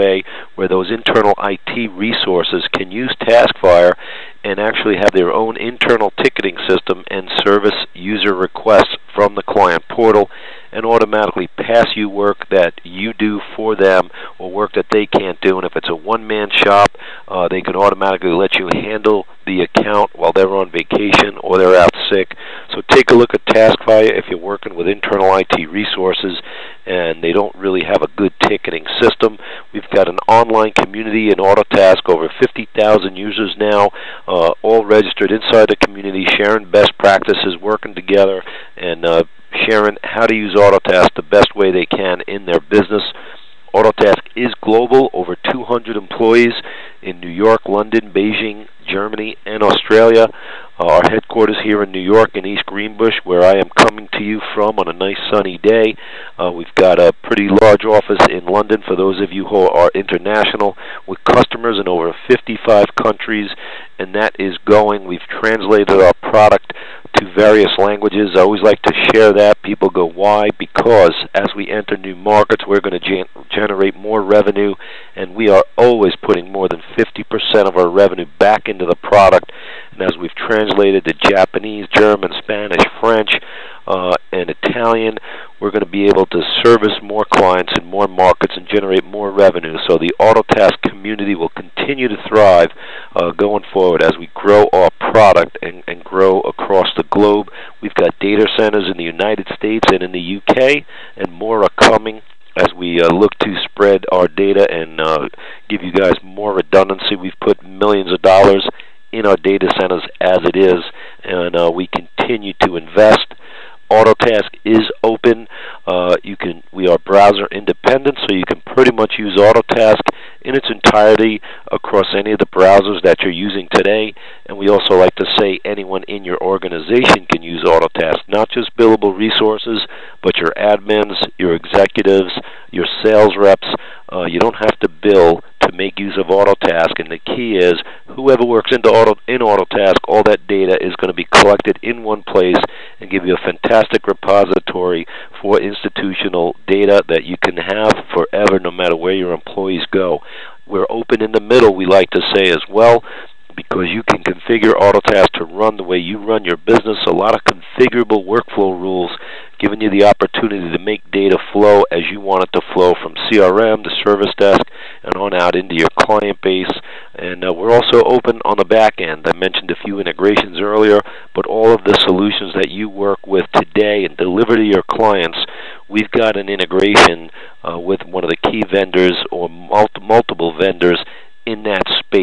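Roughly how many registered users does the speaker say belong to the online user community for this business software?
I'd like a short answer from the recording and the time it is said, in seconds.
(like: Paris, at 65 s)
over 50,000, at 32 s.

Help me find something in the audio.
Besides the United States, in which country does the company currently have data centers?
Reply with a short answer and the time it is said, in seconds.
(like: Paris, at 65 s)
UK, at 100 s.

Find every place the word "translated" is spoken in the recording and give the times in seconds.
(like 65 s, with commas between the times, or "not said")
65 s, 80 s.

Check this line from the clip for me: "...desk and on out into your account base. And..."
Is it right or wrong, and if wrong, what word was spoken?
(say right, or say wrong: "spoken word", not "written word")
wrong: "client", not "account".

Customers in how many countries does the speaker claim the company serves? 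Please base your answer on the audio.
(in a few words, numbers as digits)
over 55.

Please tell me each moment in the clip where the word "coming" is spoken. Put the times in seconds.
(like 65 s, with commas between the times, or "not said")
53 s, 101 s.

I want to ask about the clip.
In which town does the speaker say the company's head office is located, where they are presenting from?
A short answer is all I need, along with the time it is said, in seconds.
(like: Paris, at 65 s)
East Greenbush, at 52 s.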